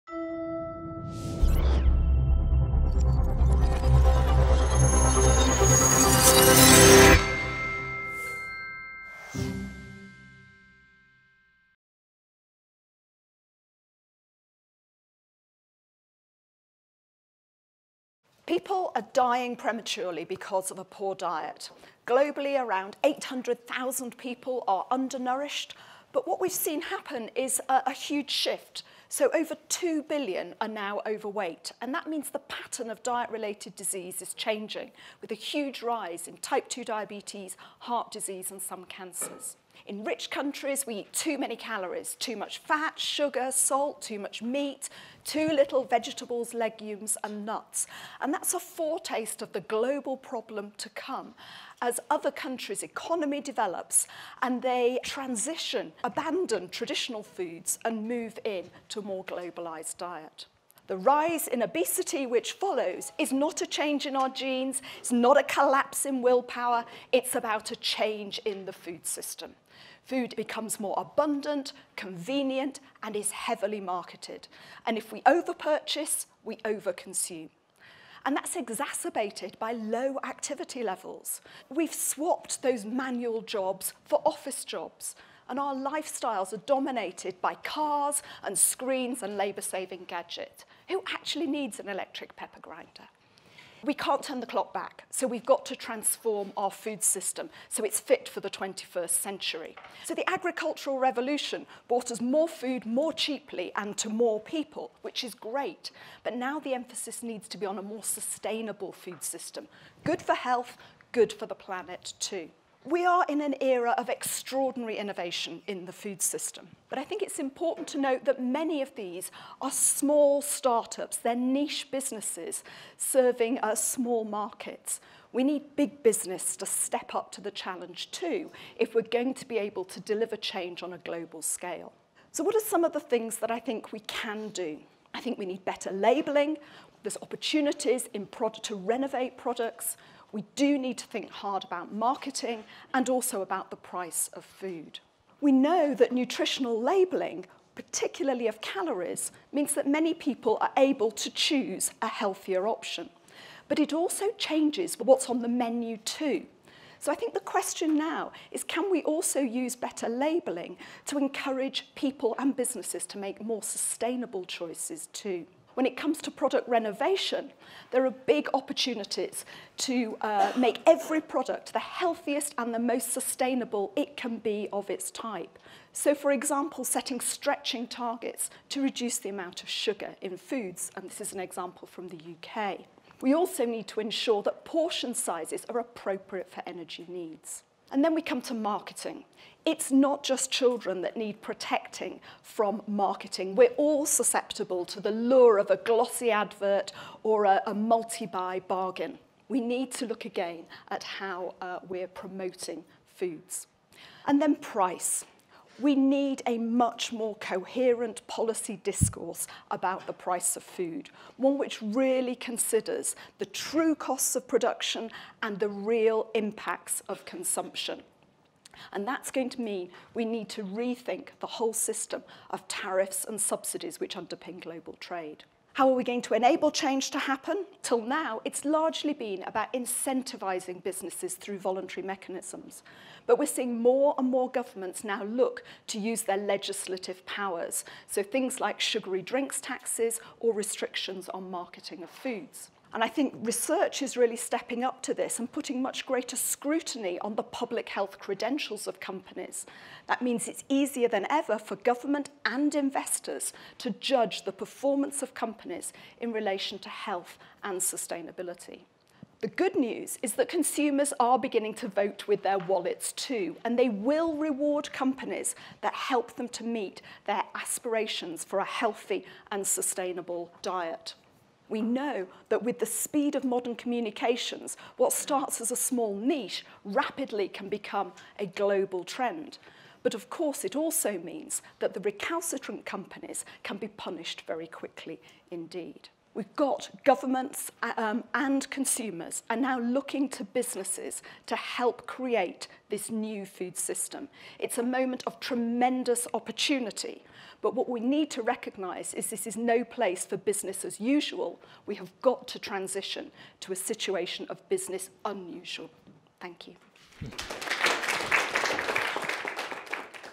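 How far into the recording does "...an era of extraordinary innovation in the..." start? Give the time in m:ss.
1:53.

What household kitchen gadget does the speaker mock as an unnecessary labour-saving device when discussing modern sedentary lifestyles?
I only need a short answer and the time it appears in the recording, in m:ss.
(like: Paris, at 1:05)
electric pepper grinder, at 1:31.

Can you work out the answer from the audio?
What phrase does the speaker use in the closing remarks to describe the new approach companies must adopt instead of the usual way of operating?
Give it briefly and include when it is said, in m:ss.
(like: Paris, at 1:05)
business unusual, at 5:04.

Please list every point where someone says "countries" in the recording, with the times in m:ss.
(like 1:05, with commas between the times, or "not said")
0:40, 0:52.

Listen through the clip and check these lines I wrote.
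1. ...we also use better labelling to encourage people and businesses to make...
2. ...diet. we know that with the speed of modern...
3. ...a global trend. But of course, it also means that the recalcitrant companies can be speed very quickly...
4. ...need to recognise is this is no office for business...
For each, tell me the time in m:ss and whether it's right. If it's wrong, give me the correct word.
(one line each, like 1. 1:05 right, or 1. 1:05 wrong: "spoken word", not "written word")
1. 2:38 right
2. 4:30 right
3. 4:38 wrong: "punished", not "speed"
4. 4:57 wrong: "place", not "office".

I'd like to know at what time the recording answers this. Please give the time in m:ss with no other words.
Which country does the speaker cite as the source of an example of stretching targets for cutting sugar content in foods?
3:02.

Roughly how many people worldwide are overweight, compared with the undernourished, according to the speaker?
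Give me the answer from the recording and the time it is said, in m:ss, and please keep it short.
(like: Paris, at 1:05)
over 2 billion, at 0:29.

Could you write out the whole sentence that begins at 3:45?
How are we going to enable change to happen?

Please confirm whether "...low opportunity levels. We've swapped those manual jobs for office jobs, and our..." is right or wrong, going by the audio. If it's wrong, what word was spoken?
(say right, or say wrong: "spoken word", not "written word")
wrong: "activity", not "opportunity".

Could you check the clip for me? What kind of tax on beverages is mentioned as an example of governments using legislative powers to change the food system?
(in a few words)
sugary drinks taxes.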